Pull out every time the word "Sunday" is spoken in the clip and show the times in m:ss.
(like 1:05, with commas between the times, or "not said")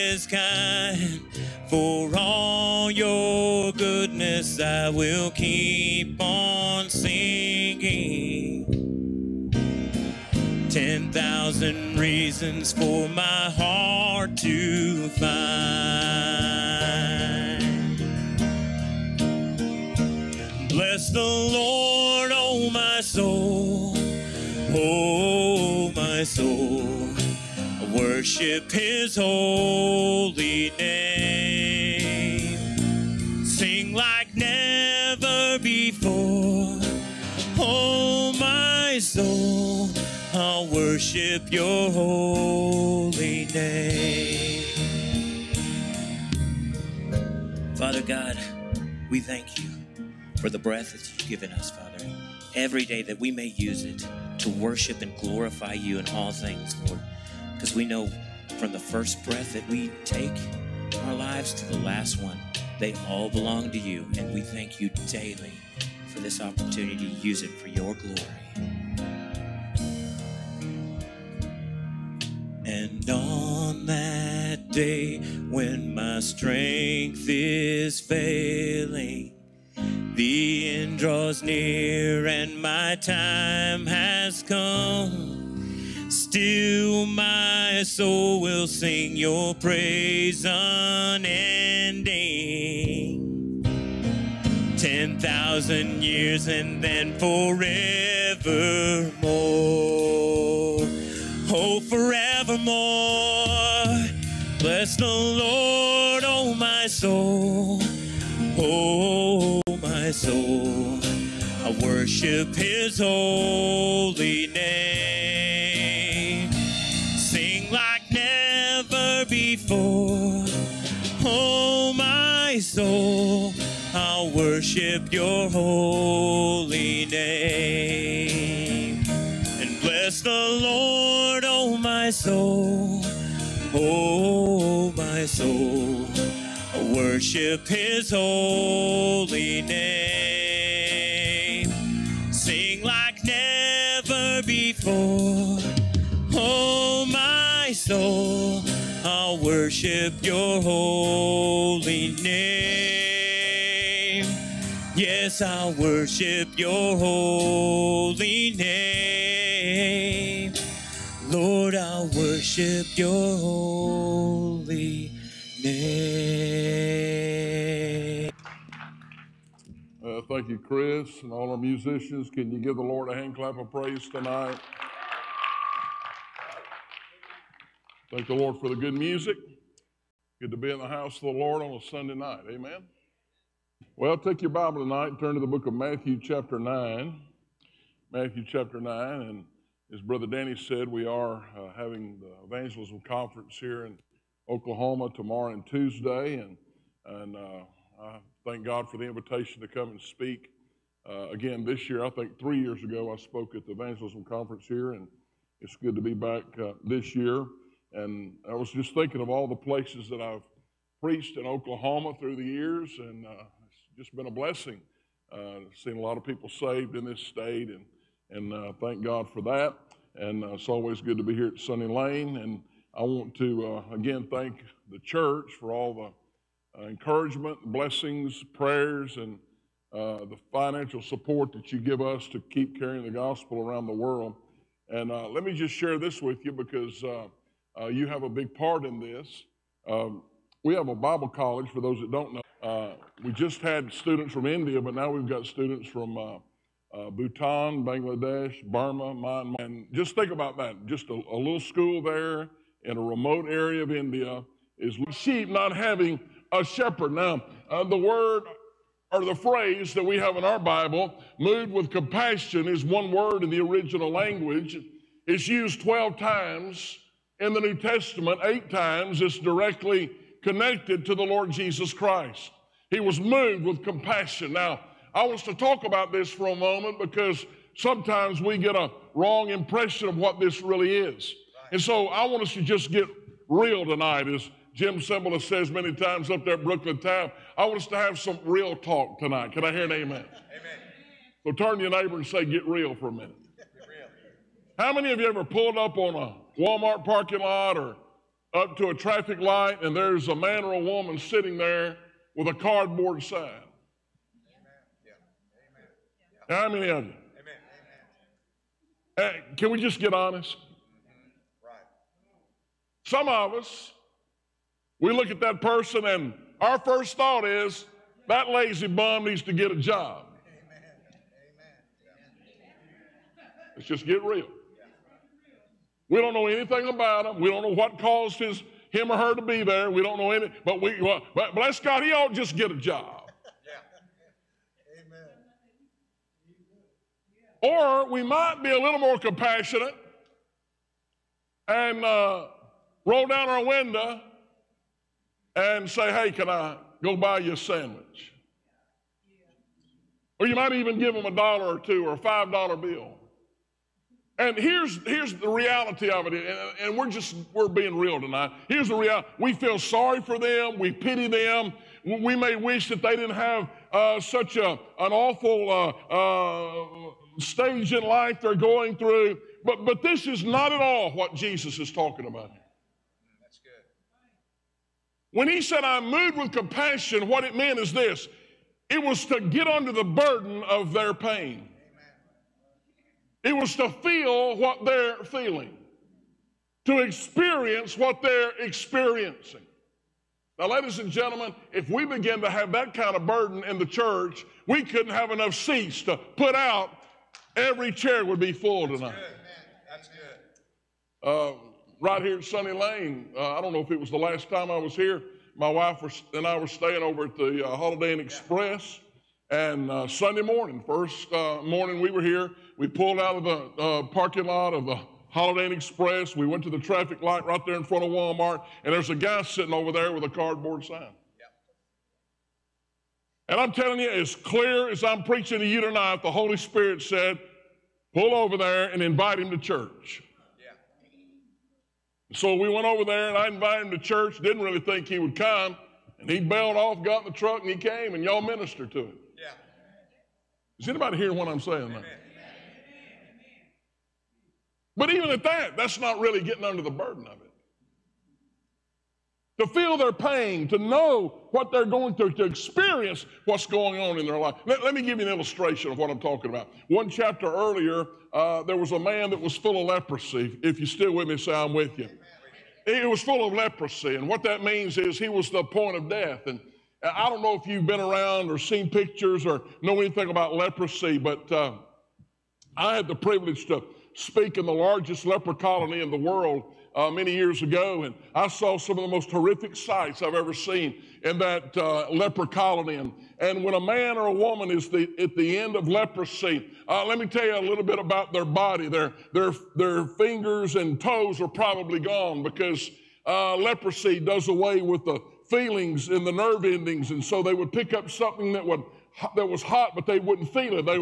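3:01, 6:50.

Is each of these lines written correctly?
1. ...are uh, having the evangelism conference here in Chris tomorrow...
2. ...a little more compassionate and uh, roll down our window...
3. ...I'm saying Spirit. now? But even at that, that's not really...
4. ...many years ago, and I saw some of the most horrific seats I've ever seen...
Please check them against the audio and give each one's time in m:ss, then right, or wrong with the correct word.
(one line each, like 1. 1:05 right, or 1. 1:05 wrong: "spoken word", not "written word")
1. 3:11 wrong: "Oklahoma", not "Chris"
2. 5:38 right
3. 7:21 wrong: "Amen", not "Spirit"
4. 7:57 wrong: "sights", not "seats".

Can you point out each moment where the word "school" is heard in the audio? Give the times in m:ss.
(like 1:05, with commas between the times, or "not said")
4:11.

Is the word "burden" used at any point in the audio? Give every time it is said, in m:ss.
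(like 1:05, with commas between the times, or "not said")
6:20, 6:33, 7:26.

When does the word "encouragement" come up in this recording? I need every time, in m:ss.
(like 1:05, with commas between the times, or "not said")
3:46.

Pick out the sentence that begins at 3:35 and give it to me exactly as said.
Uh, seen a lot of people saved in this state, and, and uh, thank God for that.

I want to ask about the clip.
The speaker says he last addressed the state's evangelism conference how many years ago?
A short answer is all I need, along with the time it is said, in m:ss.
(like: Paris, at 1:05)
3, at 3:22.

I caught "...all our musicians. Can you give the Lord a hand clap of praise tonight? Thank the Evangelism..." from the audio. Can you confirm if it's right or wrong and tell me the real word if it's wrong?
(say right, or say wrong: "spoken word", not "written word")
wrong: "Lord", not "Evangelism".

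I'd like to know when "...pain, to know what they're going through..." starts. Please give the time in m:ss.
7:30.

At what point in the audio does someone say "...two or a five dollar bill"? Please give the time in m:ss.
5:51.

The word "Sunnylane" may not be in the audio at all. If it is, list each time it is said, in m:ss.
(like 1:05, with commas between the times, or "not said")
3:41, 6:42.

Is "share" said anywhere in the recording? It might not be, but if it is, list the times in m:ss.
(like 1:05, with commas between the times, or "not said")
3:55.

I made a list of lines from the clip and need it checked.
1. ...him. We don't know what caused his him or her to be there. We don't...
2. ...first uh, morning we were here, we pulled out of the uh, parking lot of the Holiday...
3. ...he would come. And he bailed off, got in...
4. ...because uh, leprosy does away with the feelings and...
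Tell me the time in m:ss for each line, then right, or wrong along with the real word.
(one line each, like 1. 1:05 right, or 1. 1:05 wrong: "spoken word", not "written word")
1. 5:27 right
2. 6:50 right
3. 7:15 right
4. 8:12 right.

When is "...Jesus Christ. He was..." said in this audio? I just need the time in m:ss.
4:31.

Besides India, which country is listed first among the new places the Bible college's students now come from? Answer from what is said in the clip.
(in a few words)
Bhutan.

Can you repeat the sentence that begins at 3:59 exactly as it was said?
Um, we have a Bible college, for those that don't know.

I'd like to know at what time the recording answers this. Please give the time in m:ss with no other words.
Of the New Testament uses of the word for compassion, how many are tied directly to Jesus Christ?
4:28.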